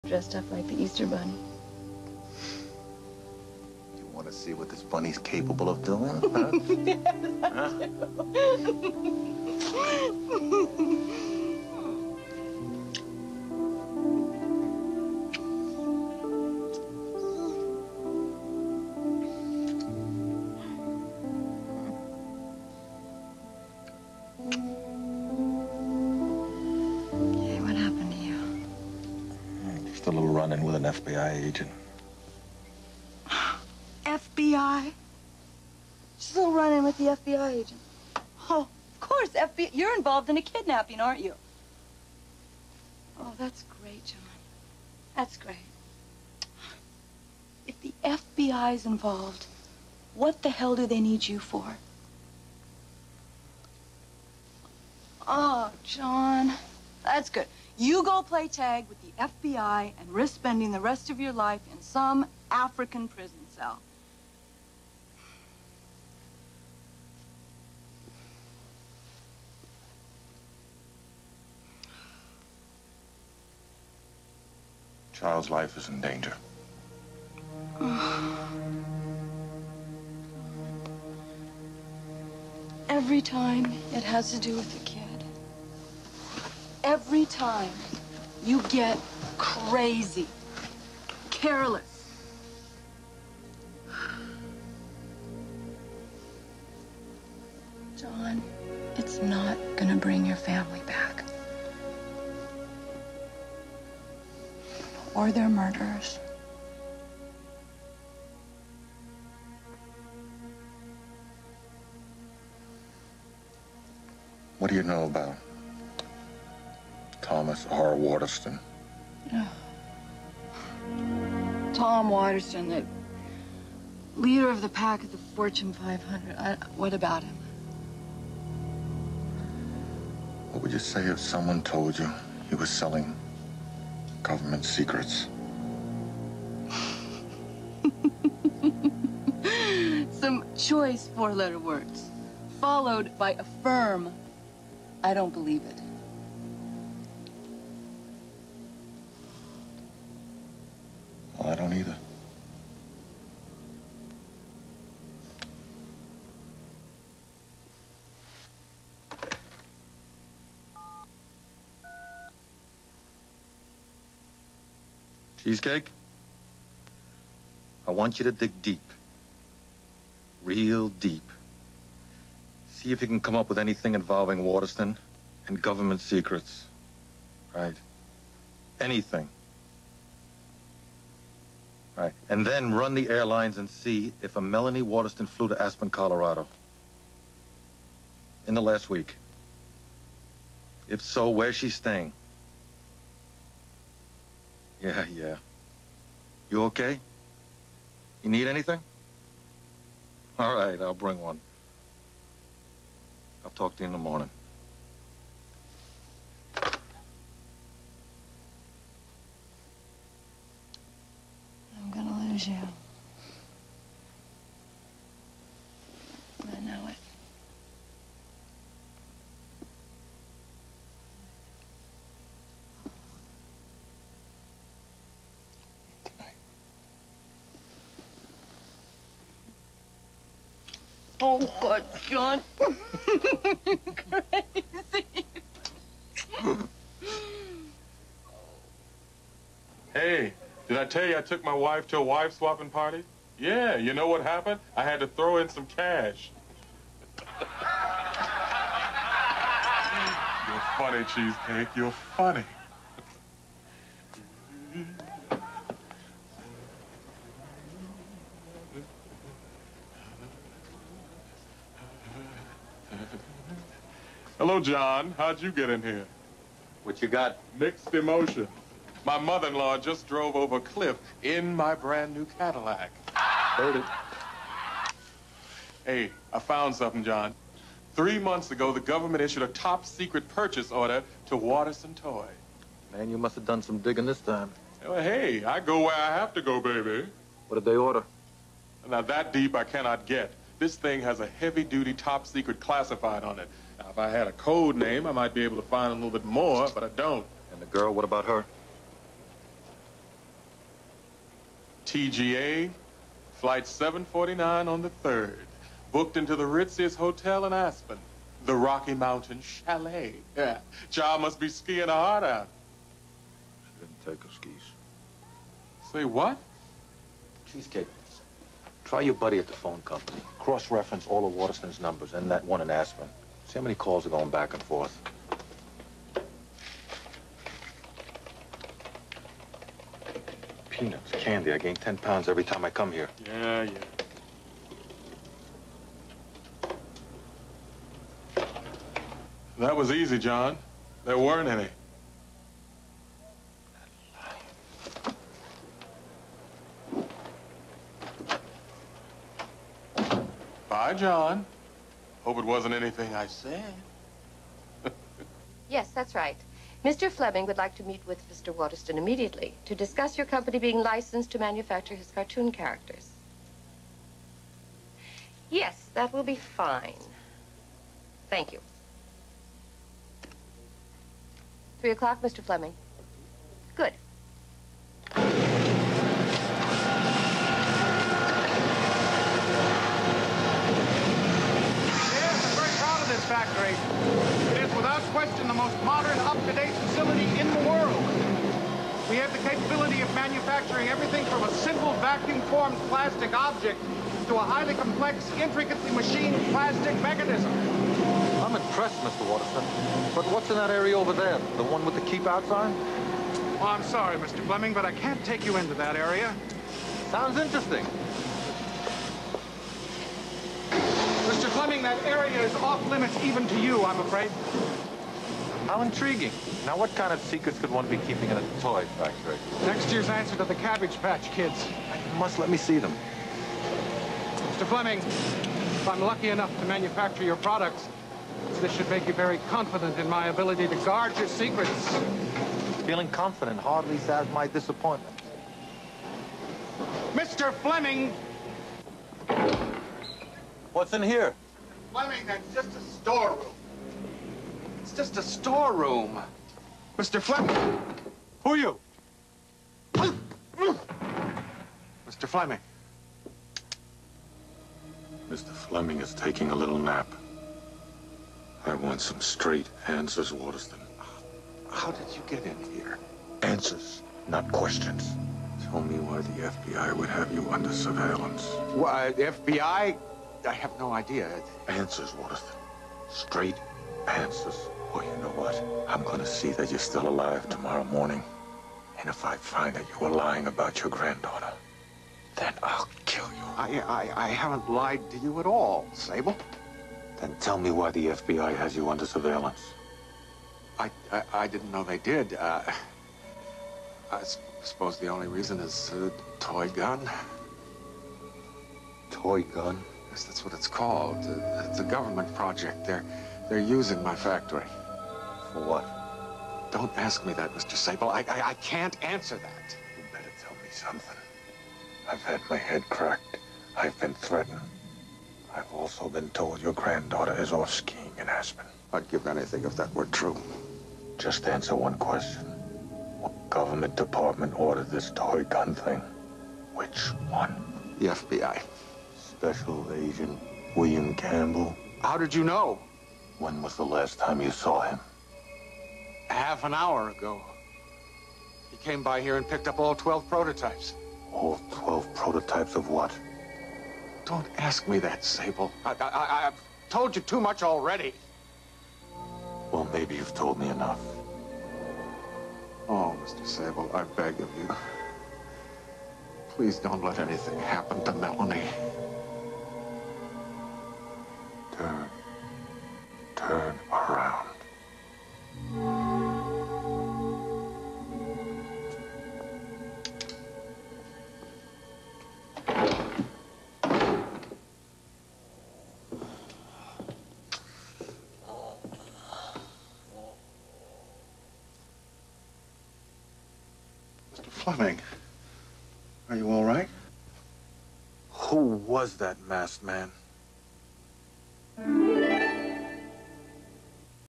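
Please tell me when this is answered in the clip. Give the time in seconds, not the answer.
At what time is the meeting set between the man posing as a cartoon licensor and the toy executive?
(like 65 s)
371 s.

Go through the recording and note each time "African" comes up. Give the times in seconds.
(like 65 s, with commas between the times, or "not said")
62 s.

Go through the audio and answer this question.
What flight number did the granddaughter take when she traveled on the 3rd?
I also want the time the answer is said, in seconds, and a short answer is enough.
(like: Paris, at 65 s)
749, at 303 s.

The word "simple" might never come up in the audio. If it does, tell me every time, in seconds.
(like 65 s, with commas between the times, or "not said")
391 s.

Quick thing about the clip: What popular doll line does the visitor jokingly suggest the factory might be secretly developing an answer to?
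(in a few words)
Cabbage Patch Kids.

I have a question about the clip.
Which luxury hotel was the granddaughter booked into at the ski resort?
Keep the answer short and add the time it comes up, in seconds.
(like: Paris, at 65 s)
Rocky Mountain Chalet, at 308 s.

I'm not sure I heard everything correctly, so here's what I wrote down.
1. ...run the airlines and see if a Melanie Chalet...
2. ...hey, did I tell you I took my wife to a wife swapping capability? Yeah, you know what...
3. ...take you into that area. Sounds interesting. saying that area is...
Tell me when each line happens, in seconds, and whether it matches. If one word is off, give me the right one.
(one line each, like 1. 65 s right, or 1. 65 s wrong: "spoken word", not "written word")
1. 182 s wrong: "Waterston", not "Chalet"
2. 239 s wrong: "party", not "capability"
3. 405 s right.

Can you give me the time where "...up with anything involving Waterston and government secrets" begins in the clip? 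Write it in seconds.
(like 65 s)
173 s.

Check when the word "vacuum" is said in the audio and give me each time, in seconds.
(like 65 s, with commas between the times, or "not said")
391 s.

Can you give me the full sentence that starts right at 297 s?
And the girl, what about her?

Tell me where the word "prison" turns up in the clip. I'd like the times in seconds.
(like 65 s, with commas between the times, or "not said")
63 s.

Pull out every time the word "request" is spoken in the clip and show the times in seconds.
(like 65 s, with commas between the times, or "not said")
not said.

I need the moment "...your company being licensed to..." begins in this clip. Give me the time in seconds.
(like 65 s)
360 s.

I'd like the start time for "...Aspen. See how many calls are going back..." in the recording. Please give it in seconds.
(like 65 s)
322 s.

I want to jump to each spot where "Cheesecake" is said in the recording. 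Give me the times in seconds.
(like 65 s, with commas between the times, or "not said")
165 s, 251 s, 317 s.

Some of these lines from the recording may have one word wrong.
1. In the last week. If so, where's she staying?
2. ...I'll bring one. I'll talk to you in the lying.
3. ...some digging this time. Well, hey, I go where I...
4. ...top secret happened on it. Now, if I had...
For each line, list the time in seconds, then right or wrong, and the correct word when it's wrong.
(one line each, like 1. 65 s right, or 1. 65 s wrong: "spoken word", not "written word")
1. 188 s right
2. 200 s wrong: "morning", not "lying"
3. 283 s right
4. 291 s wrong: "classified", not "happened".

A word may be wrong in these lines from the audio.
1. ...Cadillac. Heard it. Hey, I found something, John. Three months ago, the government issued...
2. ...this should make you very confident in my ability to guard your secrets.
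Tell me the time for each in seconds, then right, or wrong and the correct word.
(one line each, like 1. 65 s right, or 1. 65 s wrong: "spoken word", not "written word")
1. 272 s right
2. 428 s right.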